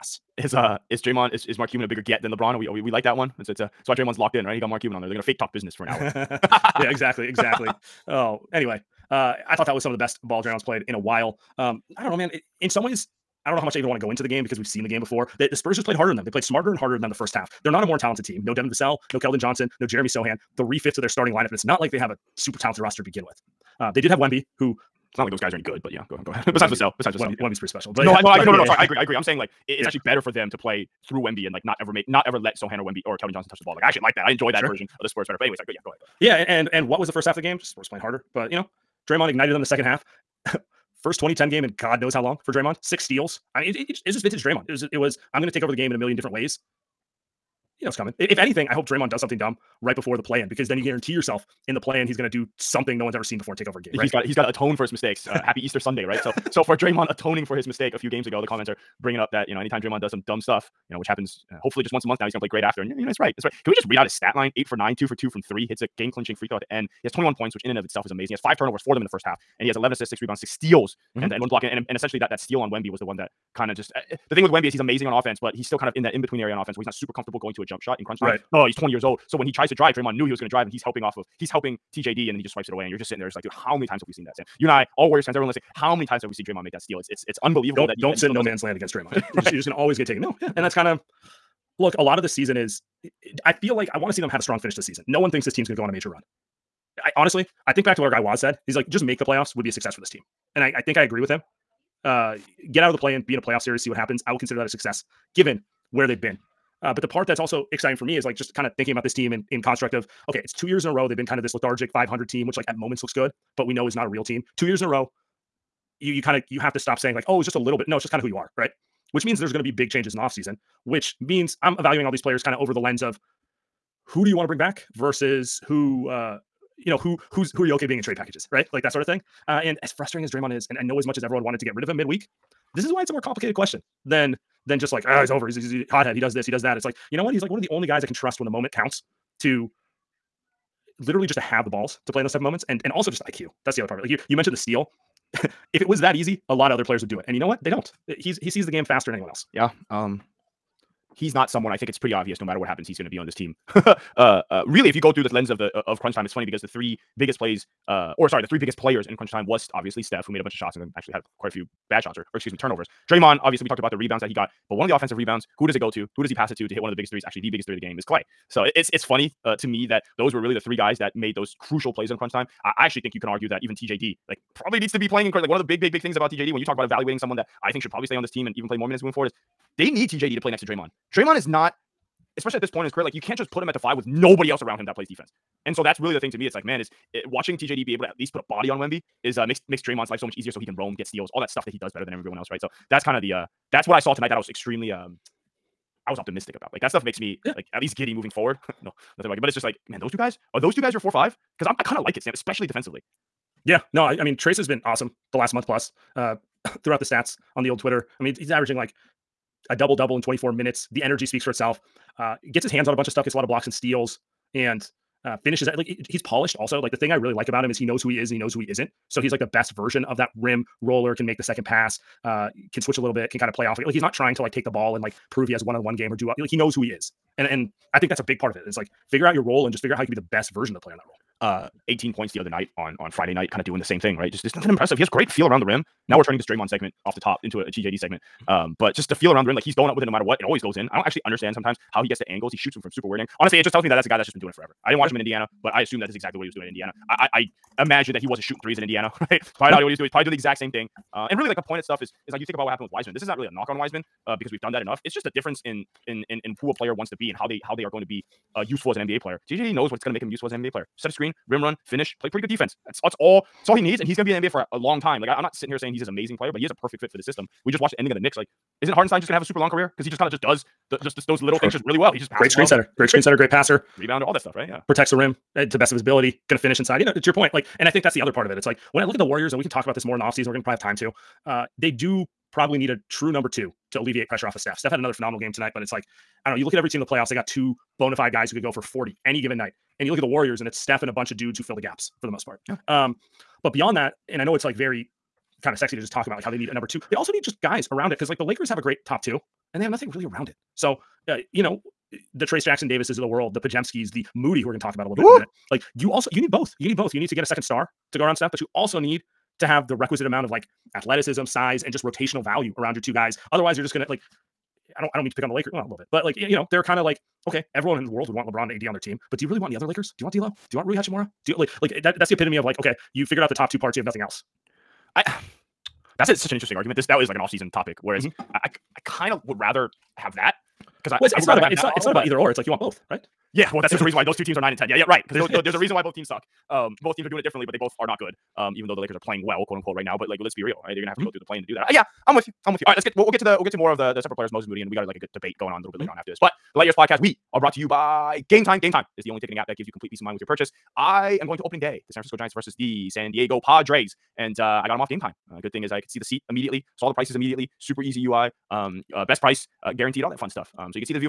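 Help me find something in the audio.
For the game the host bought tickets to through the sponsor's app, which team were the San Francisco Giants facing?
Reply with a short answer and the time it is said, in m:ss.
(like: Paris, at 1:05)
San Diego Padres, at 5:53.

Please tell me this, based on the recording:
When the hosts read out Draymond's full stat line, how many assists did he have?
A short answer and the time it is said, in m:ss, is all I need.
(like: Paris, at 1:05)
11, at 1:09.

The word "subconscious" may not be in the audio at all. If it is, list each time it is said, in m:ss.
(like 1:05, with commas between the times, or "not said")
not said.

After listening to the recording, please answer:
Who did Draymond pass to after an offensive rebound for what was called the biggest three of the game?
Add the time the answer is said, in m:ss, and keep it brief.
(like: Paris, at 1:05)
Clay, at 2:48.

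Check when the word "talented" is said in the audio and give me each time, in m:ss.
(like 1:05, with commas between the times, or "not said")
0:17, 0:22.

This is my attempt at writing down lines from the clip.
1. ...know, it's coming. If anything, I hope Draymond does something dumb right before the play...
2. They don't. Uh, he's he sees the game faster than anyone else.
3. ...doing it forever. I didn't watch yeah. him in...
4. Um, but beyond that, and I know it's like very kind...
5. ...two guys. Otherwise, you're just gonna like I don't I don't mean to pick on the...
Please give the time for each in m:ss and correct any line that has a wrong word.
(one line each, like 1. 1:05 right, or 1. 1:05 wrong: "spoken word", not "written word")
1. 0:47 right
2. 2:27 right
3. 4:04 right
4. 4:52 right
5. 5:13 right.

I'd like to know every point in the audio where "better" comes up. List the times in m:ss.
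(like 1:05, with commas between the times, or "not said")
0:30, 0:35, 3:11.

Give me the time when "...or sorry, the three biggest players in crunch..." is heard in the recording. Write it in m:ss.
2:38.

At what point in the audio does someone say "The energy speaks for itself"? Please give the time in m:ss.
3:30.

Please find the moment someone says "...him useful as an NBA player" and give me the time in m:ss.
4:20.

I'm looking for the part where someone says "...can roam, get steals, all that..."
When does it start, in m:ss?
3:10.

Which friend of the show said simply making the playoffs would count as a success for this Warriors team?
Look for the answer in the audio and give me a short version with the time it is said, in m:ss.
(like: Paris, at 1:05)
Waz, at 1:38.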